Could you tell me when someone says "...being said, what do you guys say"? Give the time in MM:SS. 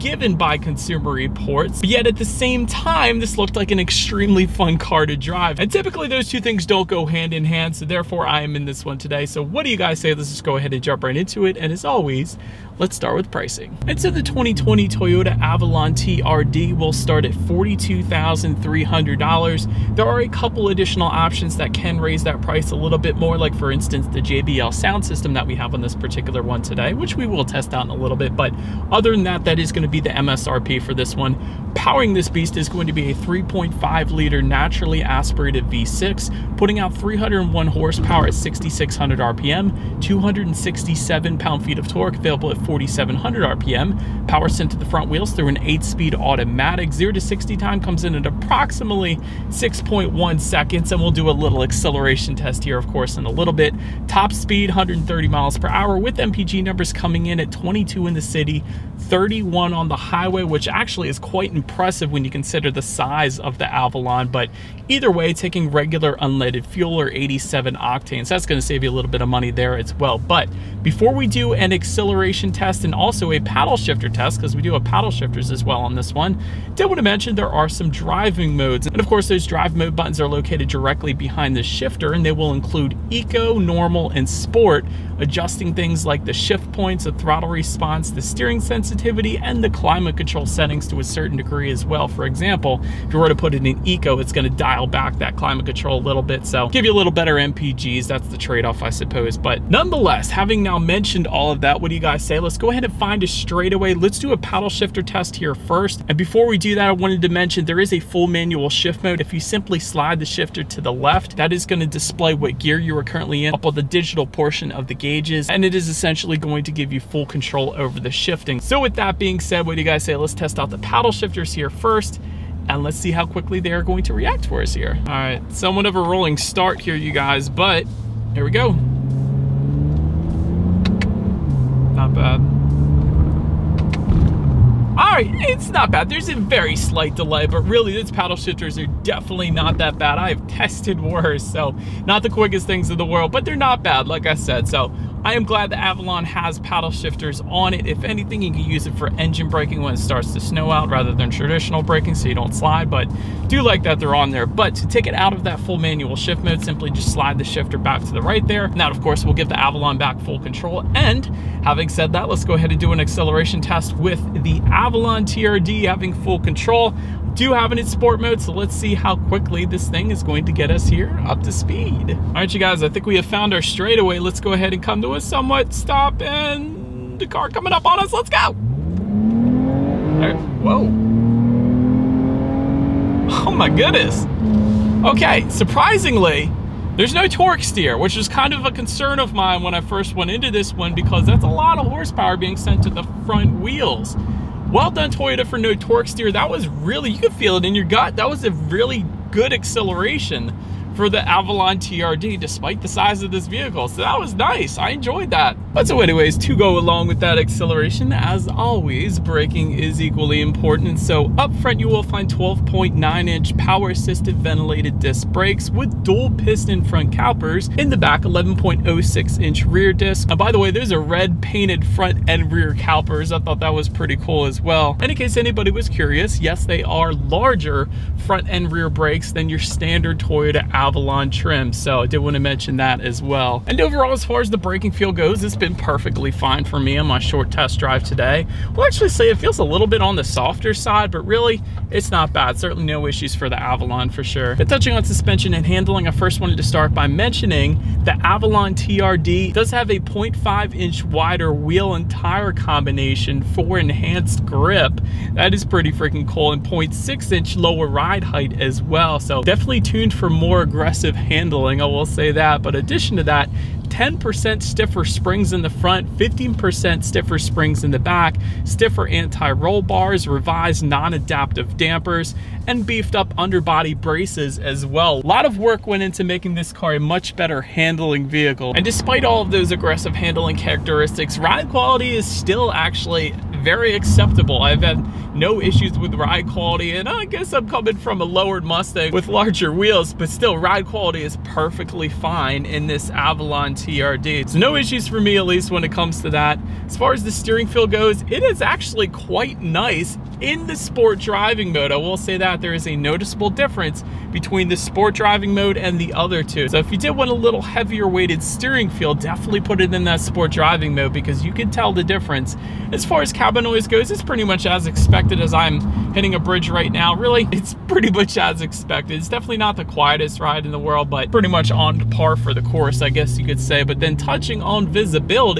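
01:59.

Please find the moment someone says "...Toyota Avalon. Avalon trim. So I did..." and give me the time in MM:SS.
03:50.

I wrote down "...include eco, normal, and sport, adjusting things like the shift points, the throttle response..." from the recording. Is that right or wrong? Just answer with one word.
right.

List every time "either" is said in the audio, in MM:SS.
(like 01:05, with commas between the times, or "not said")
01:04.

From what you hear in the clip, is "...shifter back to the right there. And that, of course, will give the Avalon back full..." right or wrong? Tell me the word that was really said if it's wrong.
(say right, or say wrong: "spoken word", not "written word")
right.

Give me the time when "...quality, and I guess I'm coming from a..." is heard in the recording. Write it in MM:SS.
04:46.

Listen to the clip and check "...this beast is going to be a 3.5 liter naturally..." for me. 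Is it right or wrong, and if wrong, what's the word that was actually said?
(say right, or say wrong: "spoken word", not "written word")
right.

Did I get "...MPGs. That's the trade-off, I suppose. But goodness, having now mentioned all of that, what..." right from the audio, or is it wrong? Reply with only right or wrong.
wrong.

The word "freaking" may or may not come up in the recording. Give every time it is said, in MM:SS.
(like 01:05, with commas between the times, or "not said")
04:15.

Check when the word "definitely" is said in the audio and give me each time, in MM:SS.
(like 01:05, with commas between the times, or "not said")
02:19, 04:19, 05:09, 05:19.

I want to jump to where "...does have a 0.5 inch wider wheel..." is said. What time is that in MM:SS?
04:09.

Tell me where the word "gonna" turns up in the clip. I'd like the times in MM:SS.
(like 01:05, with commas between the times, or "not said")
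00:29, 01:08, 01:34, 01:51.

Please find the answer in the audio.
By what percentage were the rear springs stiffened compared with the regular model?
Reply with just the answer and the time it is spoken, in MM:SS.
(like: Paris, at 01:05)
15%, at 04:26.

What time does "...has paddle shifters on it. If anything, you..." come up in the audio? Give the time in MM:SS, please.
02:26.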